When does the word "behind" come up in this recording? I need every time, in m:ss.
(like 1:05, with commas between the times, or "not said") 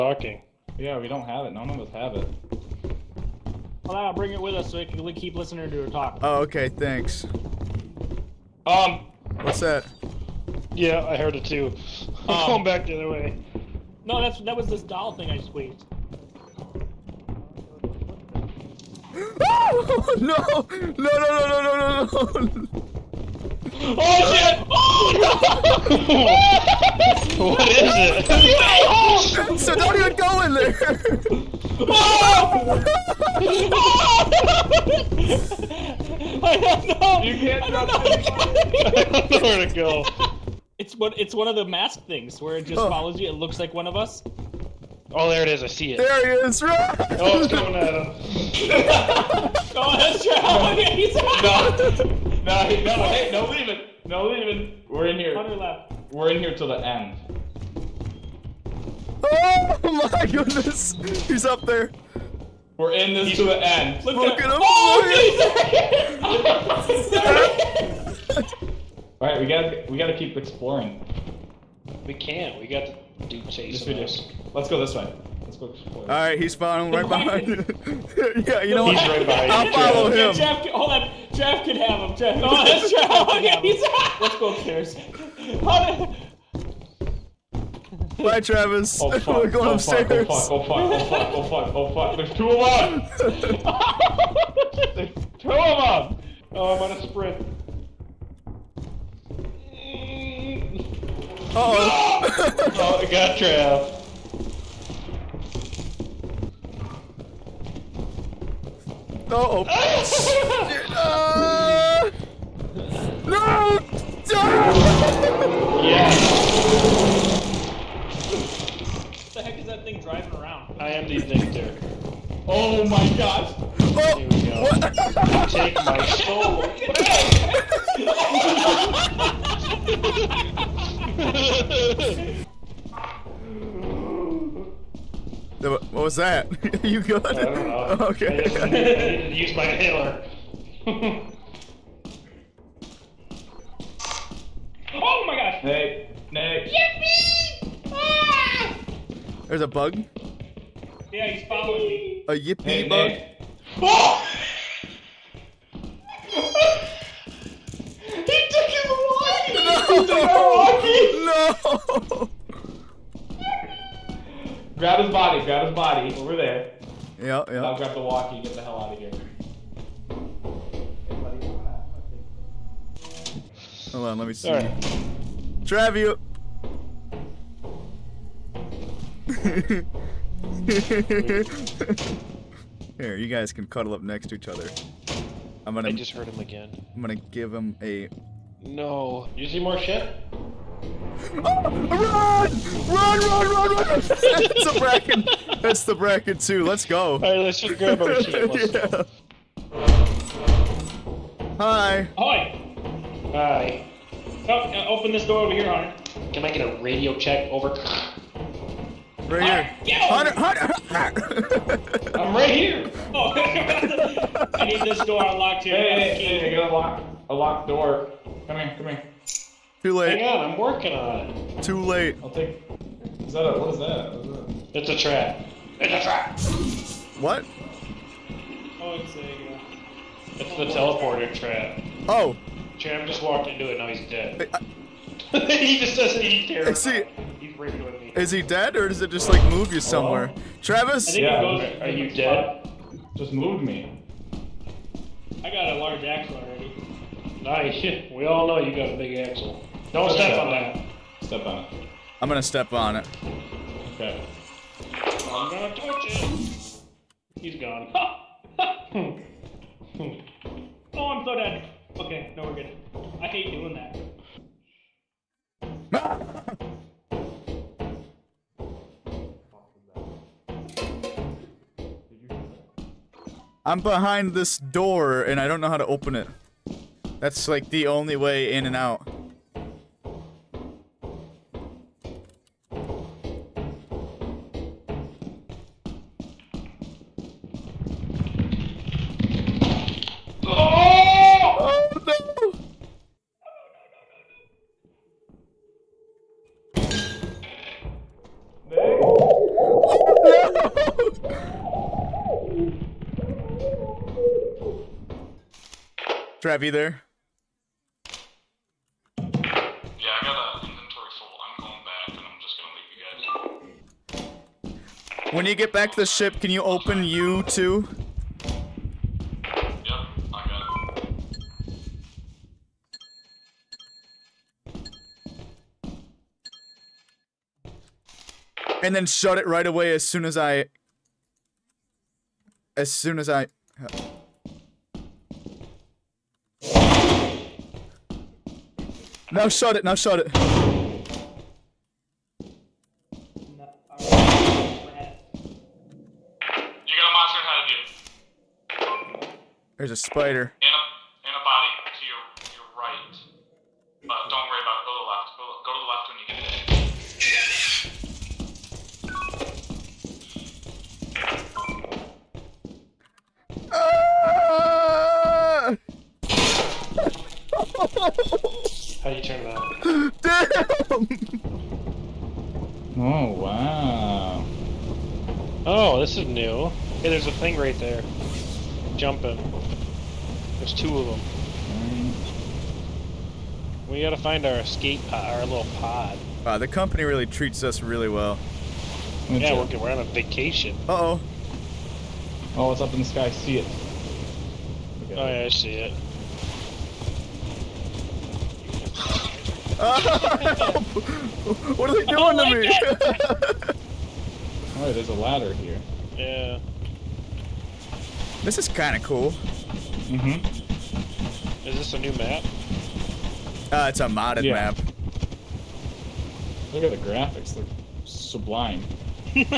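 1:17, 4:33.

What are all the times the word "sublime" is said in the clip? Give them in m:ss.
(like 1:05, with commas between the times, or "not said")
6:58.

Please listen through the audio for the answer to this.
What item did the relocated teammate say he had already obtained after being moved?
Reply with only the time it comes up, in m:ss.
4:05.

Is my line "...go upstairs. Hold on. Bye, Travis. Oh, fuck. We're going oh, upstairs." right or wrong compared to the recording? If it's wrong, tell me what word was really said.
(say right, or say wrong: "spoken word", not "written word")
right.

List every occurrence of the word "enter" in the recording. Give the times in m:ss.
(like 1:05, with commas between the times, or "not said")
not said.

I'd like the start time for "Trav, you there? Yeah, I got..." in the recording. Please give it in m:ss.
5:06.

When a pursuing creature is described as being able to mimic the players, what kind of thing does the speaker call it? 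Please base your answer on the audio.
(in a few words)
mask things.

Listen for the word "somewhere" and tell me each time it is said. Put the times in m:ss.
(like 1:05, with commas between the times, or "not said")
3:59.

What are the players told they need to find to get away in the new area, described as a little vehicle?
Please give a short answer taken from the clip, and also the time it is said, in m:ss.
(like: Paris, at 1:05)
escape pod, at 6:24.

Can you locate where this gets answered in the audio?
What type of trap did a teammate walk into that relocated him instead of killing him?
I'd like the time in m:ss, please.
3:50.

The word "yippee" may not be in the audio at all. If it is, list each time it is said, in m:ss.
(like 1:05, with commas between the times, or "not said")
2:26, 2:32.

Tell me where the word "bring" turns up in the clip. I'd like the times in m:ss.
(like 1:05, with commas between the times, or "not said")
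0:04.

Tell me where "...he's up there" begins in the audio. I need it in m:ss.
1:01.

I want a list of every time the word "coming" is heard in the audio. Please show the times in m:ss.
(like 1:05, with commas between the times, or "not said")
0:47.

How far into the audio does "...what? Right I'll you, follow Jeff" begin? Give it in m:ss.
1:19.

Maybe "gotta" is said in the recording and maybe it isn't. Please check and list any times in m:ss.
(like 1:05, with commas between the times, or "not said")
1:09, 6:24.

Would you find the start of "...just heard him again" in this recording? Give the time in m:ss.
3:05.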